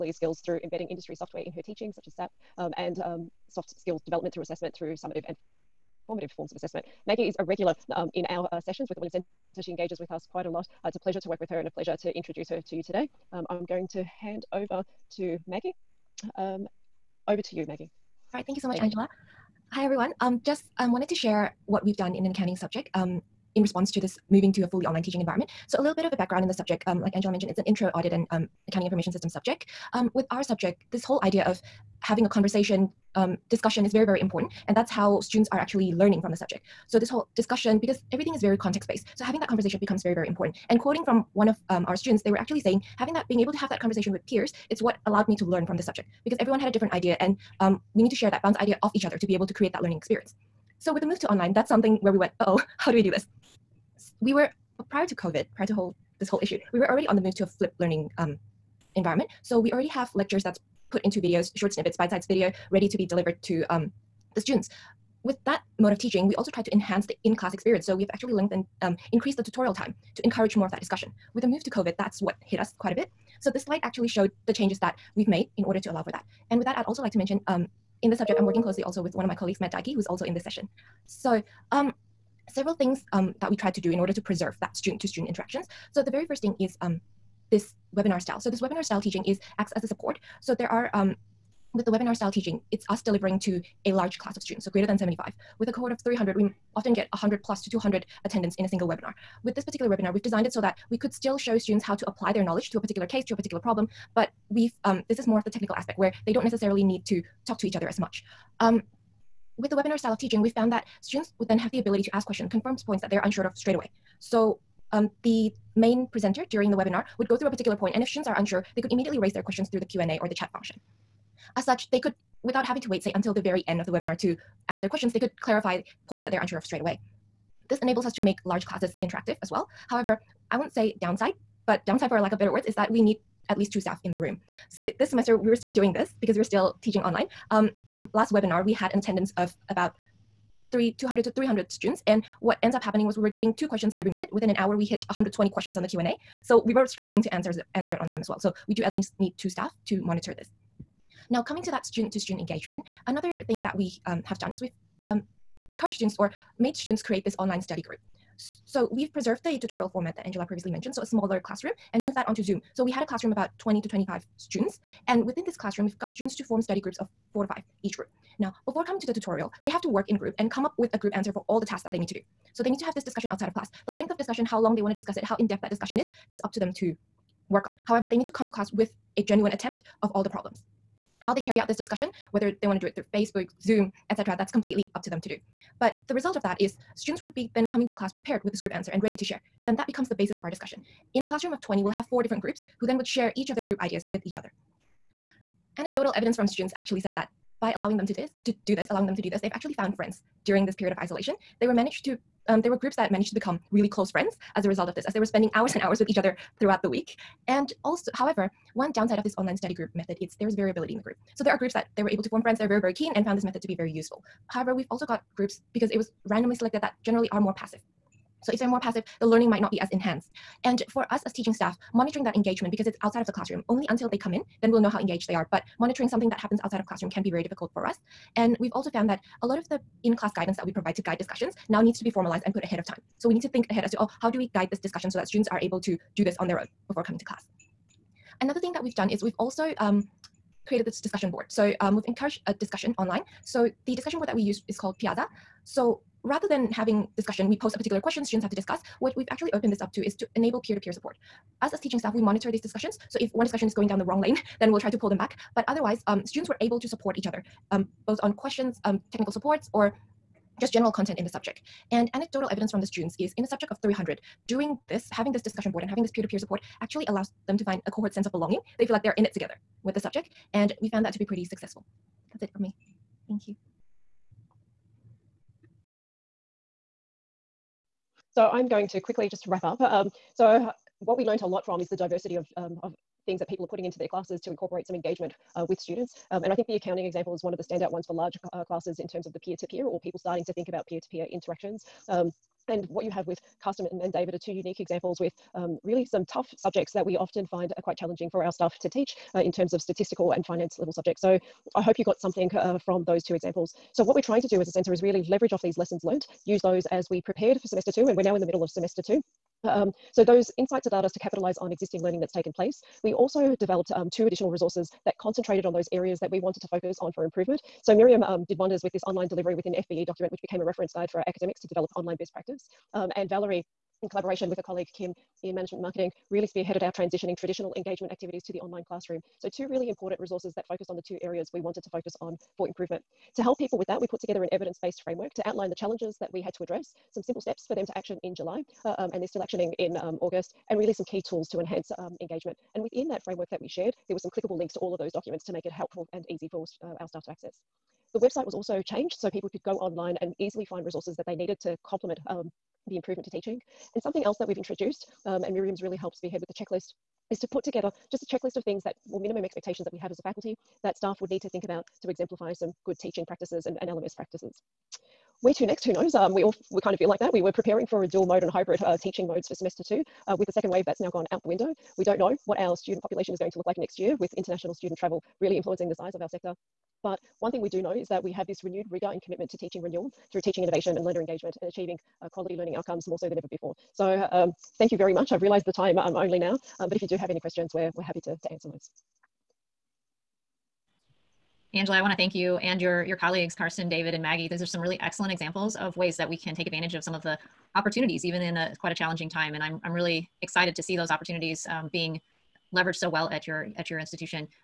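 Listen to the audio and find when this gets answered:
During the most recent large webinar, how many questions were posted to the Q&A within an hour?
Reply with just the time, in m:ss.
2:25.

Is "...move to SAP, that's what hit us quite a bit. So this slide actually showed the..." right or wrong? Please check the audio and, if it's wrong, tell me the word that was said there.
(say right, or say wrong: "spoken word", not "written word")
wrong: "COVID", not "SAP".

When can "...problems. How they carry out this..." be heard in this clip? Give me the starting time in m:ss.
3:00.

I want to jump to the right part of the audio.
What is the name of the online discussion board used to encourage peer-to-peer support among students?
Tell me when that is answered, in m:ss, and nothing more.
4:04.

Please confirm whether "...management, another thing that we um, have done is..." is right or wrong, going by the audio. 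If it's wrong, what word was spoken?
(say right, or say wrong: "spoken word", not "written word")
wrong: "engagement", not "management".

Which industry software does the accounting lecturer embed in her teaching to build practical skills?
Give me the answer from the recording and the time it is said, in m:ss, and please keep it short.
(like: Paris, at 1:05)
SAP, at 0:02.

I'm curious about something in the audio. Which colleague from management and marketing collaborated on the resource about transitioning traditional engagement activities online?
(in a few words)
Kim.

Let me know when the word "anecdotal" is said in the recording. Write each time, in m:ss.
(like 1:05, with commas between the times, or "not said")
3:15, 4:22.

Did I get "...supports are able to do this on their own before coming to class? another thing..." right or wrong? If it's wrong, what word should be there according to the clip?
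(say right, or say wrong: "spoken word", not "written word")
wrong: "students", not "supports".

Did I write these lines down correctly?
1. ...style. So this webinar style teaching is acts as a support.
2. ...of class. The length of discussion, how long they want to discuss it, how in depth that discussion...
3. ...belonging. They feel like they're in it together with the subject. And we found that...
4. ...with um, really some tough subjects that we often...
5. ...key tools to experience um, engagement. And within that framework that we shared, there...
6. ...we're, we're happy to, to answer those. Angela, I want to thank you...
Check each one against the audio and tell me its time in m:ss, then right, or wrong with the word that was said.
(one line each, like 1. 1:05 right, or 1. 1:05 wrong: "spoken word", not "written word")
1. 1:28 right
2. 2:53 right
3. 4:28 right
4. 4:55 right
5. 5:41 wrong: "enhance", not "experience"
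6. 6:27 right.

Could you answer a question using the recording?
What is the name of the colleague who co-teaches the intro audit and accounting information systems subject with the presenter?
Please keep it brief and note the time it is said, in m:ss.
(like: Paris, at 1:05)
Matt Dyke, at 1:19.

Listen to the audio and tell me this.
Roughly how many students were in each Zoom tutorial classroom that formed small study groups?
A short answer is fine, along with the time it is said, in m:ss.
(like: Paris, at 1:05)
20 to 25, at 2:43.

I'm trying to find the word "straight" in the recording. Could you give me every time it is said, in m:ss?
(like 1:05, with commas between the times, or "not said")
1:53, 2:06.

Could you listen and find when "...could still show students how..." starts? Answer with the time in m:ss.
1:40.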